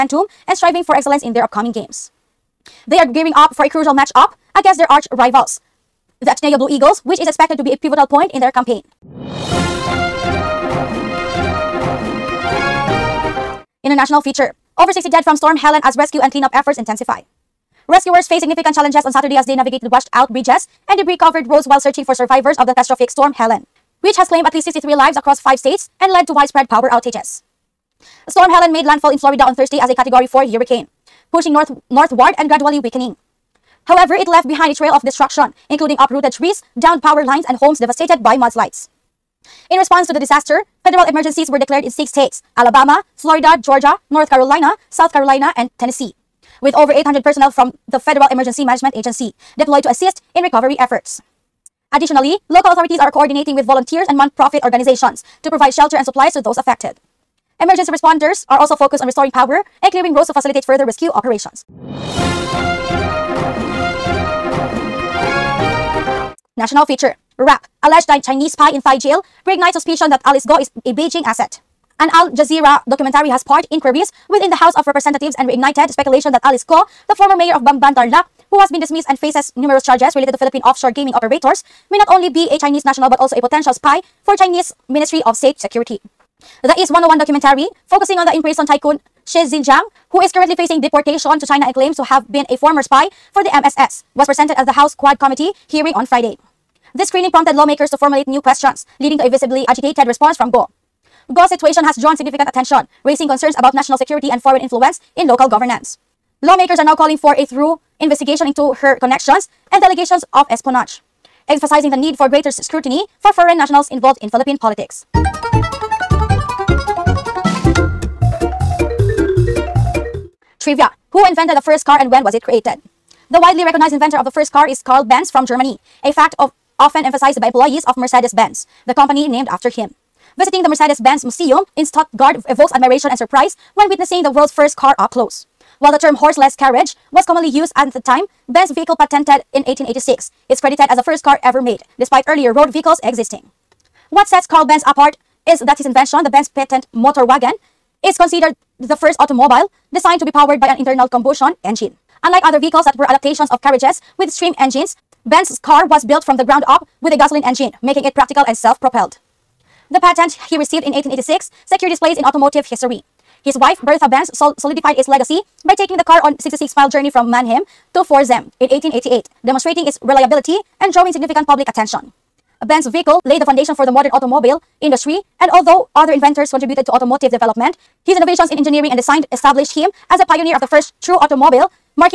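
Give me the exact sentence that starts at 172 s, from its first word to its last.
Benz's vehicle laid the foundation for the modern automobile industry, and although other inventors contributed to automotive development.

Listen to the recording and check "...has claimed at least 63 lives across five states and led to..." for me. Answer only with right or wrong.
right.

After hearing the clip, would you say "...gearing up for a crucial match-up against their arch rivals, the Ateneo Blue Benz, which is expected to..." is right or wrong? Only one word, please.
wrong.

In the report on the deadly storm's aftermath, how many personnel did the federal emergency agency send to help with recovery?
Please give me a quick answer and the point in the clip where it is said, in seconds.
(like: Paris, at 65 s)
800, at 46 s.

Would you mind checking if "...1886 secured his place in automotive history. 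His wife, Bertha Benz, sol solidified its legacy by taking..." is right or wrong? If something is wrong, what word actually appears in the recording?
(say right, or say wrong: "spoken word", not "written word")
right.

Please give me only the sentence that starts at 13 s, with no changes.
International feature over 60 dead from Storm Helene as rescue and cleanup efforts intensify.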